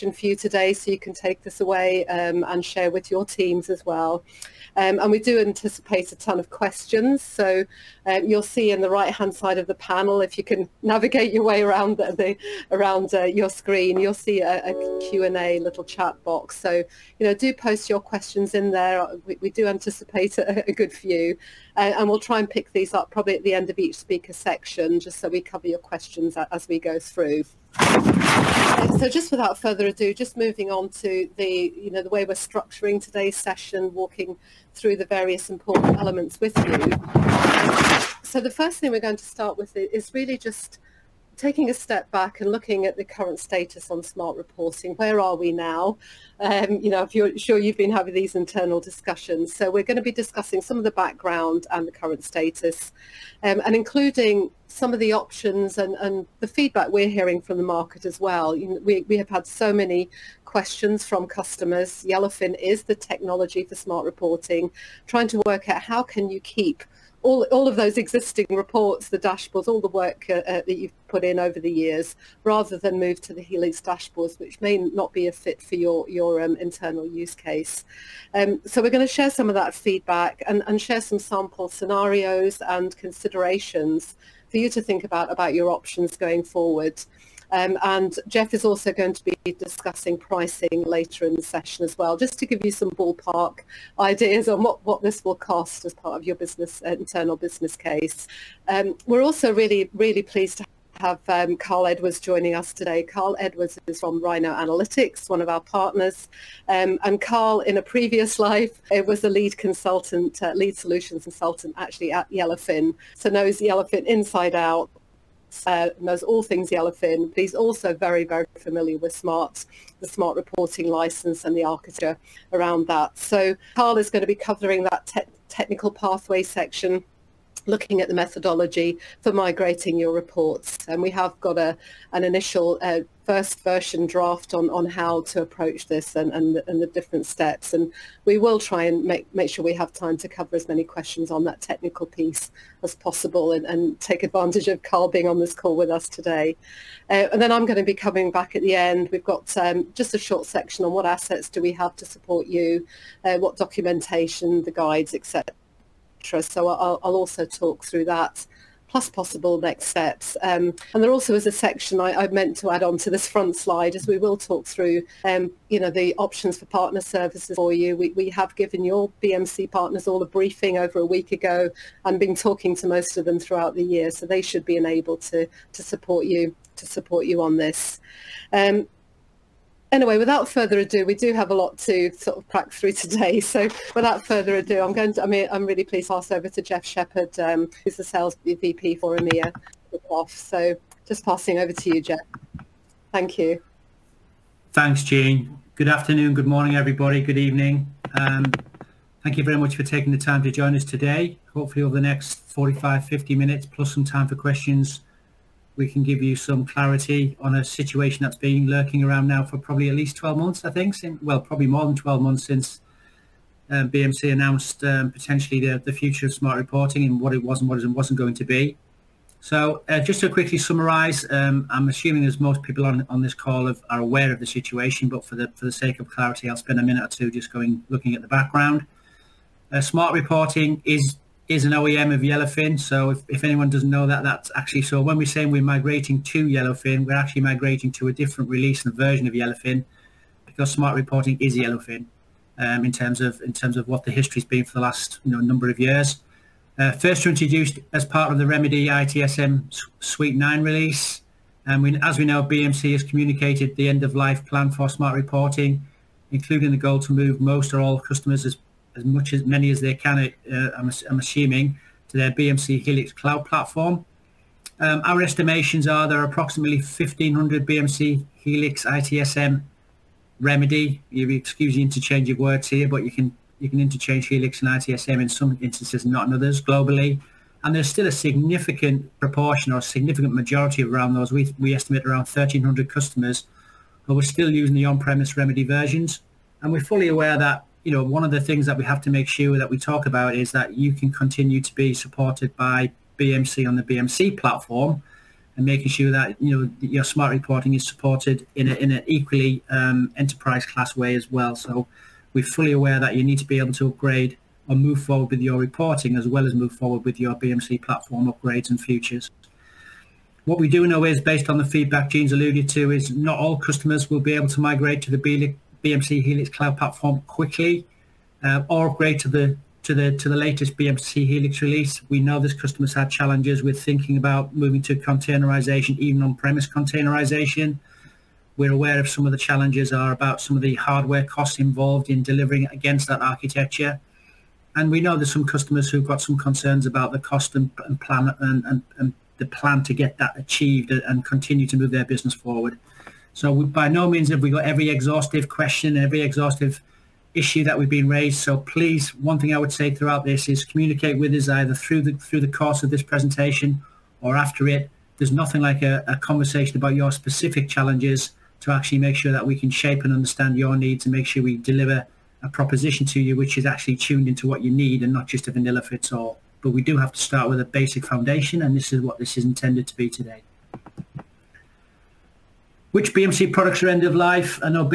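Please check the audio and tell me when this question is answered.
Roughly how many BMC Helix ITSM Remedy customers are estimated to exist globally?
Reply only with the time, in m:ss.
4:26.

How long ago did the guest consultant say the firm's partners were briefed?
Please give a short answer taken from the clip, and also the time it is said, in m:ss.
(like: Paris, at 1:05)
over a week ago, at 2:50.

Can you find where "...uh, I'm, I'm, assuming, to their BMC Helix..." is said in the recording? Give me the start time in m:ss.
4:20.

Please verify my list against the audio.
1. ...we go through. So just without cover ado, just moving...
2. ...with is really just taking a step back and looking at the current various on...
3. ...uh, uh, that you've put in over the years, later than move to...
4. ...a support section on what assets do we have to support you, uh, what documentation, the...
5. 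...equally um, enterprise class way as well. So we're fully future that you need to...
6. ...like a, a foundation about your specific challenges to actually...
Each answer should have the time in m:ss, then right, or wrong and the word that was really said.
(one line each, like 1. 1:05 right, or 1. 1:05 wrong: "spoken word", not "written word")
1. 0:26 wrong: "further", not "cover"
2. 0:39 wrong: "status", not "various"
3. 1:10 wrong: "rather", not "later"
4. 2:30 wrong: "short", not "support"
5. 4:59 wrong: "aware", not "future"
6. 5:55 wrong: "conversation", not "foundation".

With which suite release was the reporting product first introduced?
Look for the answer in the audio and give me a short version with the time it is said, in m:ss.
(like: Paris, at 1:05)
Remedy ITSM Suite 9, at 4:08.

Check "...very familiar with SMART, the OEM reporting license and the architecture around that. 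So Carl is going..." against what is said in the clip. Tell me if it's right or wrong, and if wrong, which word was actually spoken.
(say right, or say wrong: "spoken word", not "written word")
wrong: "SMART", not "OEM".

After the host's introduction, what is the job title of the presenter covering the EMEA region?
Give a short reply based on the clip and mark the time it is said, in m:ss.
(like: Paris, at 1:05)
sales VP, at 3:08.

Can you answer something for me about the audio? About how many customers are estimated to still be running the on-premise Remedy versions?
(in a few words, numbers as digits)
1,300.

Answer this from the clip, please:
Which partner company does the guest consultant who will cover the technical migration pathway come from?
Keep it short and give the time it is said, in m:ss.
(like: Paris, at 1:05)
Rhino Analytics, at 1:44.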